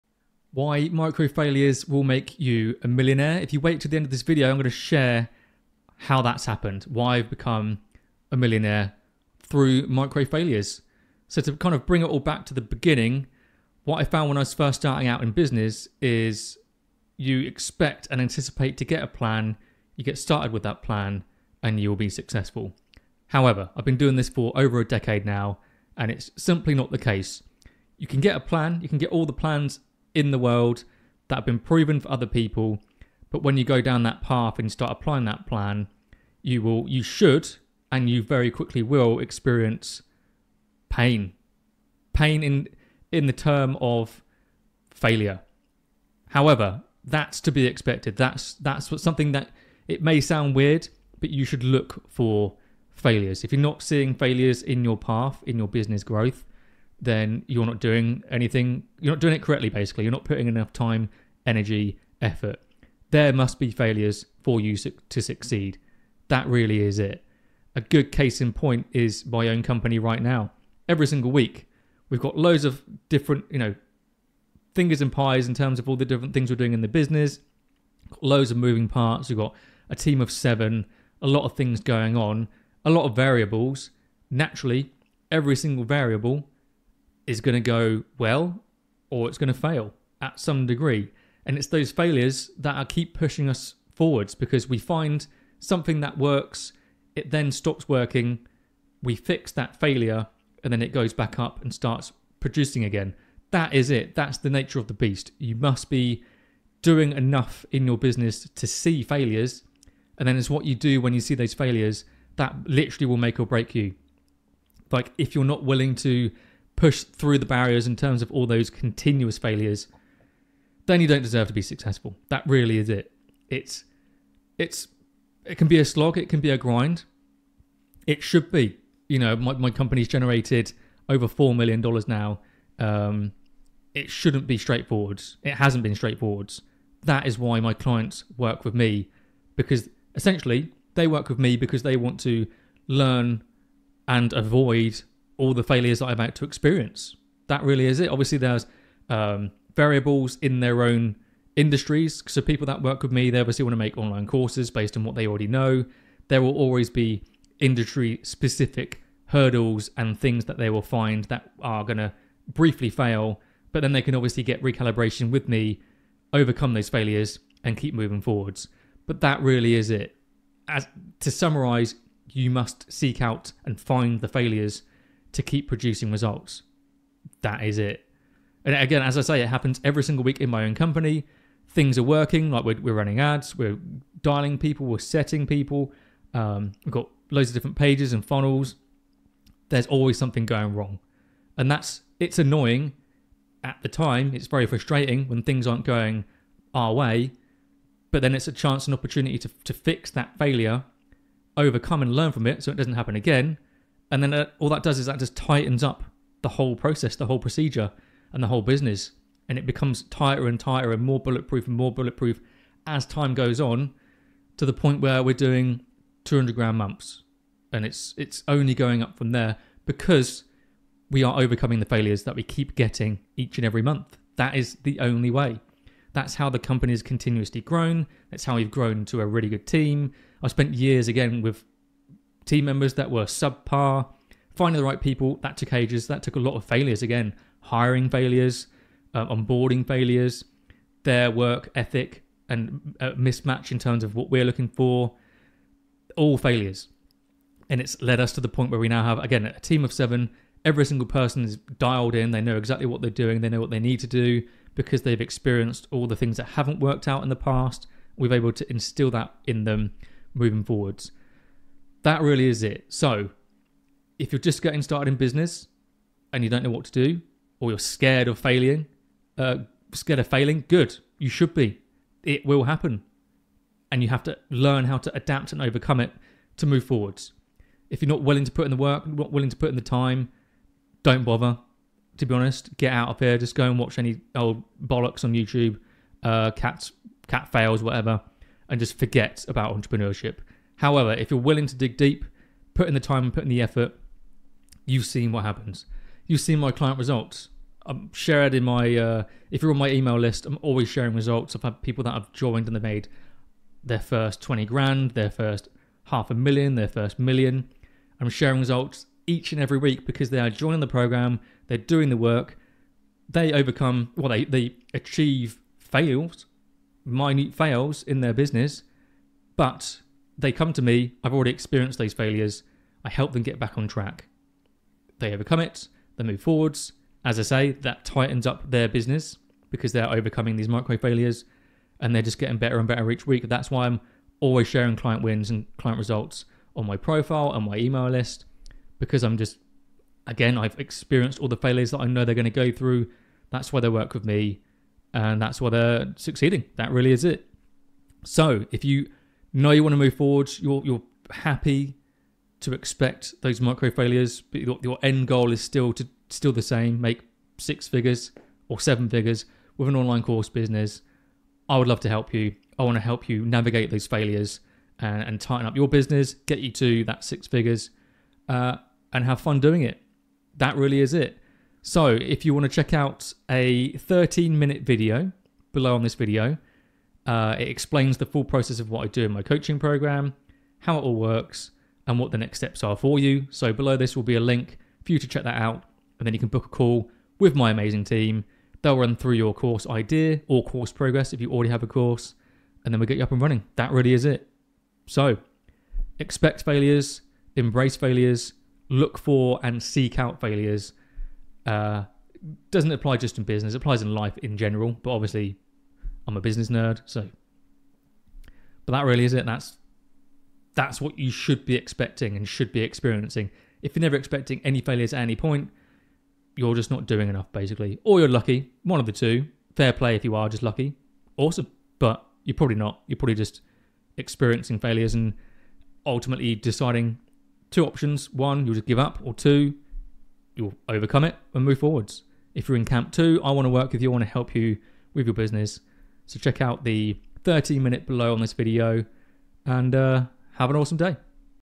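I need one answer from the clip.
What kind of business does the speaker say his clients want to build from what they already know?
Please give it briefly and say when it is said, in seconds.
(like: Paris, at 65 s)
online courses, at 153 s.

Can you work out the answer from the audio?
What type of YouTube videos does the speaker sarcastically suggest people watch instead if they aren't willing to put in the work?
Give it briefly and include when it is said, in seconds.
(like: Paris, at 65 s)
cat fails, at 286 s.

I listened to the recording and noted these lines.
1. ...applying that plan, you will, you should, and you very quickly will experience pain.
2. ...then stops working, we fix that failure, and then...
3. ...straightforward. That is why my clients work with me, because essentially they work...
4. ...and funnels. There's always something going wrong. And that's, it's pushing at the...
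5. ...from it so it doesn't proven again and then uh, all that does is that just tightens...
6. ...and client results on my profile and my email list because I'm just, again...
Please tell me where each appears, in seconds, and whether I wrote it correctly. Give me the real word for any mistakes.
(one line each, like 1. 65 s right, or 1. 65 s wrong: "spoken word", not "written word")
1. 34 s right
2. 97 s right
3. 135 s right
4. 188 s wrong: "annoying", not "pushing"
5. 202 s wrong: "happen", not "proven"
6. 335 s right.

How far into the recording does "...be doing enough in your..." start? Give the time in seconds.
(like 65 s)
105 s.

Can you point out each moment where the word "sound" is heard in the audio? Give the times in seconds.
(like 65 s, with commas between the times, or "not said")
50 s.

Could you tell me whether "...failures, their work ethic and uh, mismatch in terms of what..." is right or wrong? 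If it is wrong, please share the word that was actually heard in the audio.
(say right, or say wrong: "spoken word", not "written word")
right.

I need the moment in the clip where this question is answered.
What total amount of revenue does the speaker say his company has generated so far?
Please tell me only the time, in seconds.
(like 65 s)
131 s.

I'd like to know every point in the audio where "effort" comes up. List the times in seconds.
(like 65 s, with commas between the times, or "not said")
62 s, 293 s.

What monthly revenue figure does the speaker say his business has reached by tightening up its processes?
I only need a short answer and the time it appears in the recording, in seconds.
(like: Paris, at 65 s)
200 grand, at 216 s.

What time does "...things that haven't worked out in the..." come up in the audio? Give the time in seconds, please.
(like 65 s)
256 s.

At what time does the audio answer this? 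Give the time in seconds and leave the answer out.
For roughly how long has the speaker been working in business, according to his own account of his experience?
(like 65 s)
24 s.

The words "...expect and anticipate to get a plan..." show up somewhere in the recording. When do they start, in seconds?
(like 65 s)
17 s.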